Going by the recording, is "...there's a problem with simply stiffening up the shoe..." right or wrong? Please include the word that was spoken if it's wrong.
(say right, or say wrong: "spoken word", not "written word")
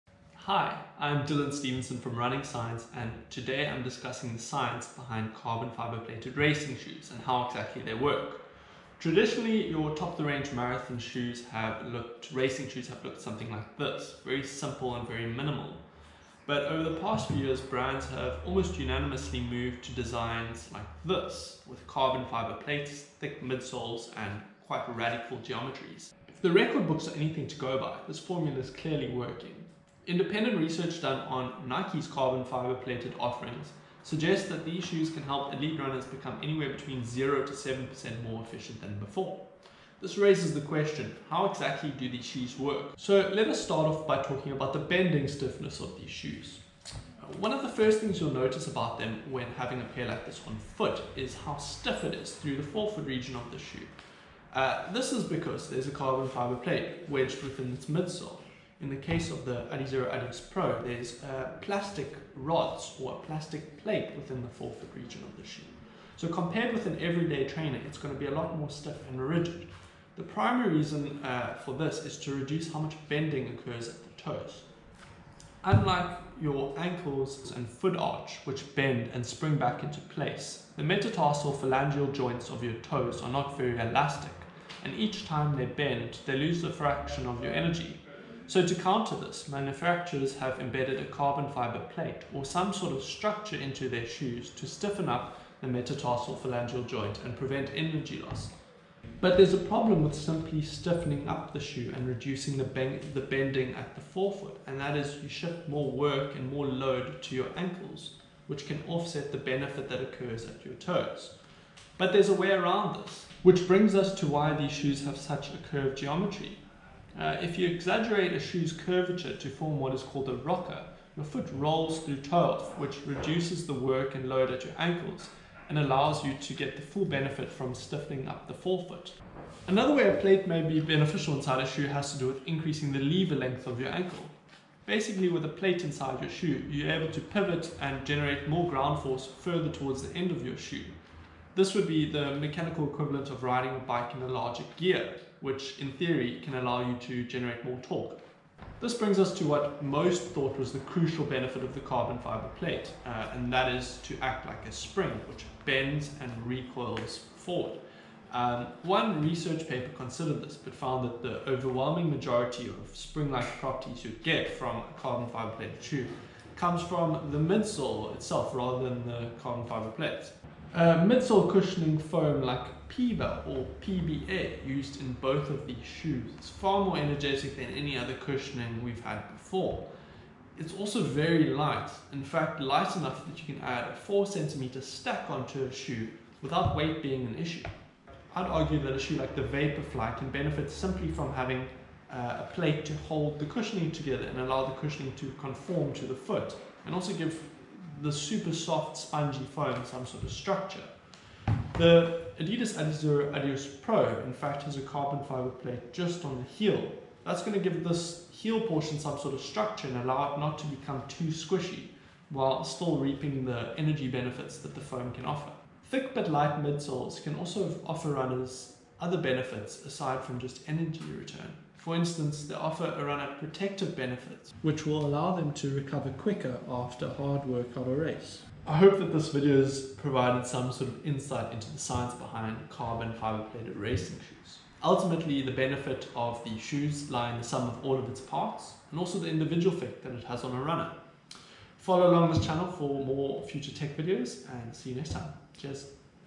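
right.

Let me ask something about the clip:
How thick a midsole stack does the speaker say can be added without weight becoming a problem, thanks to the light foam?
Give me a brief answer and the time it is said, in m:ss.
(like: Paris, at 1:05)
4cm, at 3:04.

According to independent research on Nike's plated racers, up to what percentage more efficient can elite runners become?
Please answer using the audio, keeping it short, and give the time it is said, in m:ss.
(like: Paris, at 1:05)
7%, at 0:37.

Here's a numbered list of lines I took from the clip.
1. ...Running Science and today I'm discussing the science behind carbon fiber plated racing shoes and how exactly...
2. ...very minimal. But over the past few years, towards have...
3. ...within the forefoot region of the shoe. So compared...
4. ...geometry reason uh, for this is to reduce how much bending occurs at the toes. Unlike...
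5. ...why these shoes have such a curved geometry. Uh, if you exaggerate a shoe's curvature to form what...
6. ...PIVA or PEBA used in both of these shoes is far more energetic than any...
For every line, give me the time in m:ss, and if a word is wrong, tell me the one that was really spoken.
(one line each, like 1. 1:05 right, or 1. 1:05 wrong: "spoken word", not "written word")
1. 0:02 right
2. 0:15 wrong: "brands", not "towards"
3. 1:04 right
4. 1:10 wrong: "primary", not "geometry"
5. 1:54 right
6. 2:52 right.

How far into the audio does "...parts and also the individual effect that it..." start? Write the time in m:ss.
3:58.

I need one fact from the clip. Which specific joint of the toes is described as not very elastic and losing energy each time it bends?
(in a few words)
metatarsal phalangeal joint.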